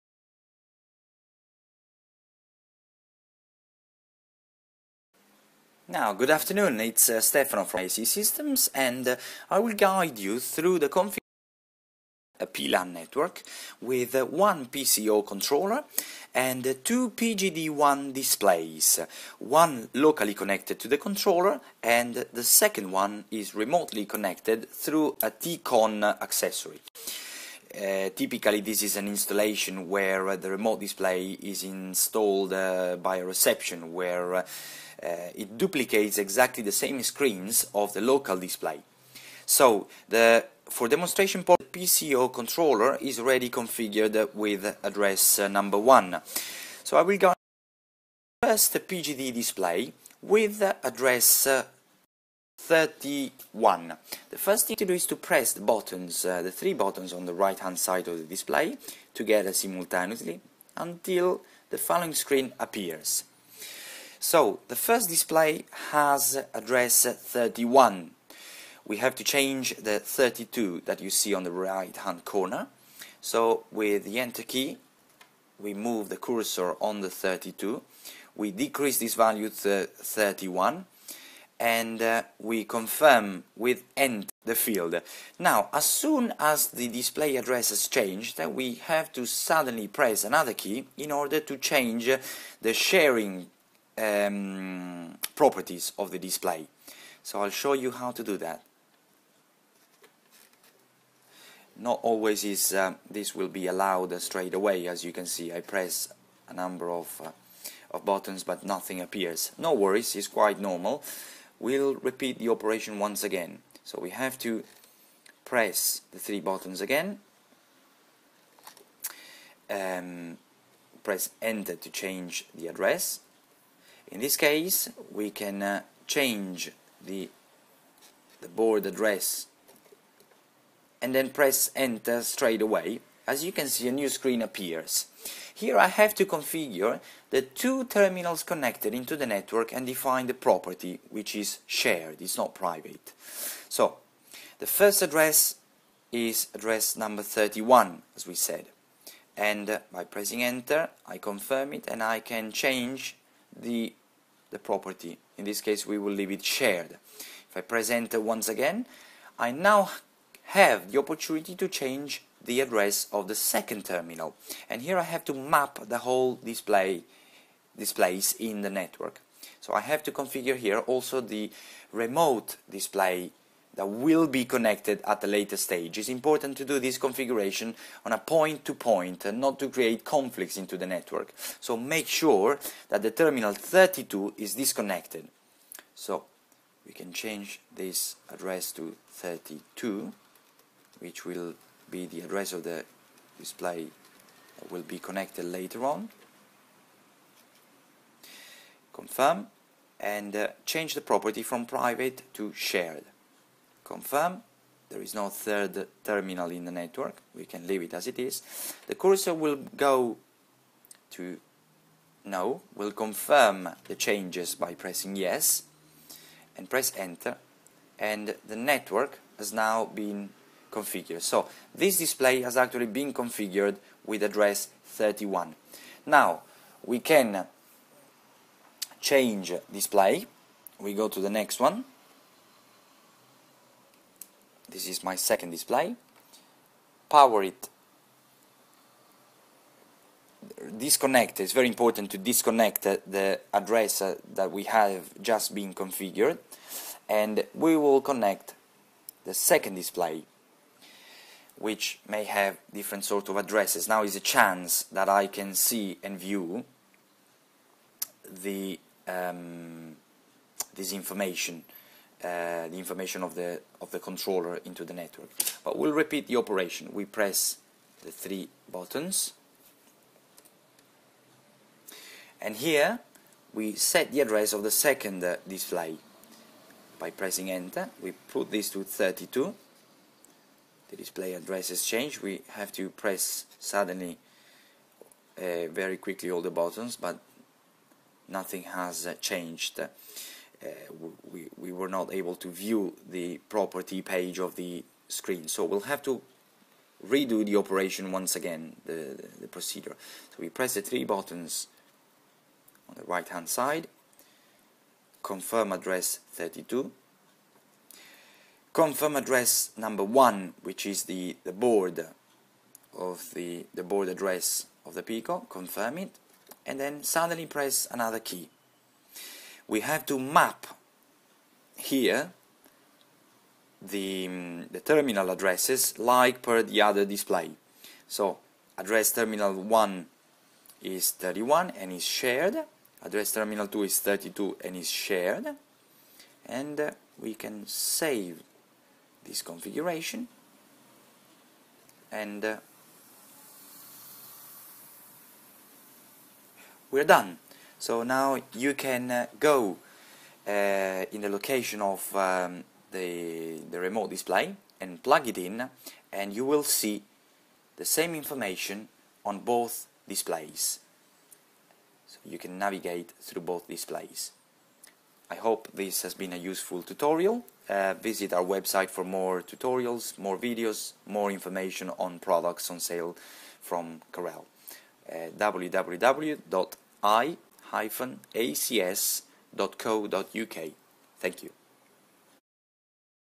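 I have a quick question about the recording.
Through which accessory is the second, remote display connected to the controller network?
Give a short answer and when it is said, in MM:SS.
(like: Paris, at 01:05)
TCON, at 00:25.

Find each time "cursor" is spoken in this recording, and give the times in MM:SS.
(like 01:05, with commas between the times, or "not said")
01:16, 03:28.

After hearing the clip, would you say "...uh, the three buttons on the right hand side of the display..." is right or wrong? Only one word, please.
right.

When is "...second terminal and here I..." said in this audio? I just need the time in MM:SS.
02:43.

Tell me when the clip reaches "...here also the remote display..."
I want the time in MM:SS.
02:50.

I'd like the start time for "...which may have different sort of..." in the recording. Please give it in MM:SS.
04:11.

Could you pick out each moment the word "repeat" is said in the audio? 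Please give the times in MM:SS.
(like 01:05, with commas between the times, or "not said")
01:51, 04:25.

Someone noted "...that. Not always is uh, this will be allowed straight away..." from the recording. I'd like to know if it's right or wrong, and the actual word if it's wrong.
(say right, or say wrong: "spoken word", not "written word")
right.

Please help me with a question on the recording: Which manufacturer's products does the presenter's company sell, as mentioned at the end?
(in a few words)
Carel.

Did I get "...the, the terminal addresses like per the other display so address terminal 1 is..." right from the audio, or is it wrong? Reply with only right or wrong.
right.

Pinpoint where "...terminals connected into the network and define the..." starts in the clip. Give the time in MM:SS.
02:17.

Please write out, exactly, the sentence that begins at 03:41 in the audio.
So this display has actually been configured with address 31.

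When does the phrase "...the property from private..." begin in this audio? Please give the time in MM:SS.
03:20.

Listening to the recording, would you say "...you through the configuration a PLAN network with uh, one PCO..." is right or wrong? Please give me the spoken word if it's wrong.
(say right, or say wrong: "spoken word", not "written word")
right.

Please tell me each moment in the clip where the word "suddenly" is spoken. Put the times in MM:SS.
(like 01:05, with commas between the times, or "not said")
01:29, 04:43, 05:17.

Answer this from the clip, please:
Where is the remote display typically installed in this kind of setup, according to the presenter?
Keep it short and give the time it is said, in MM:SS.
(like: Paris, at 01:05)
by a reception, at 00:32.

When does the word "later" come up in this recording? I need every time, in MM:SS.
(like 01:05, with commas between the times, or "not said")
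02:55, 03:15.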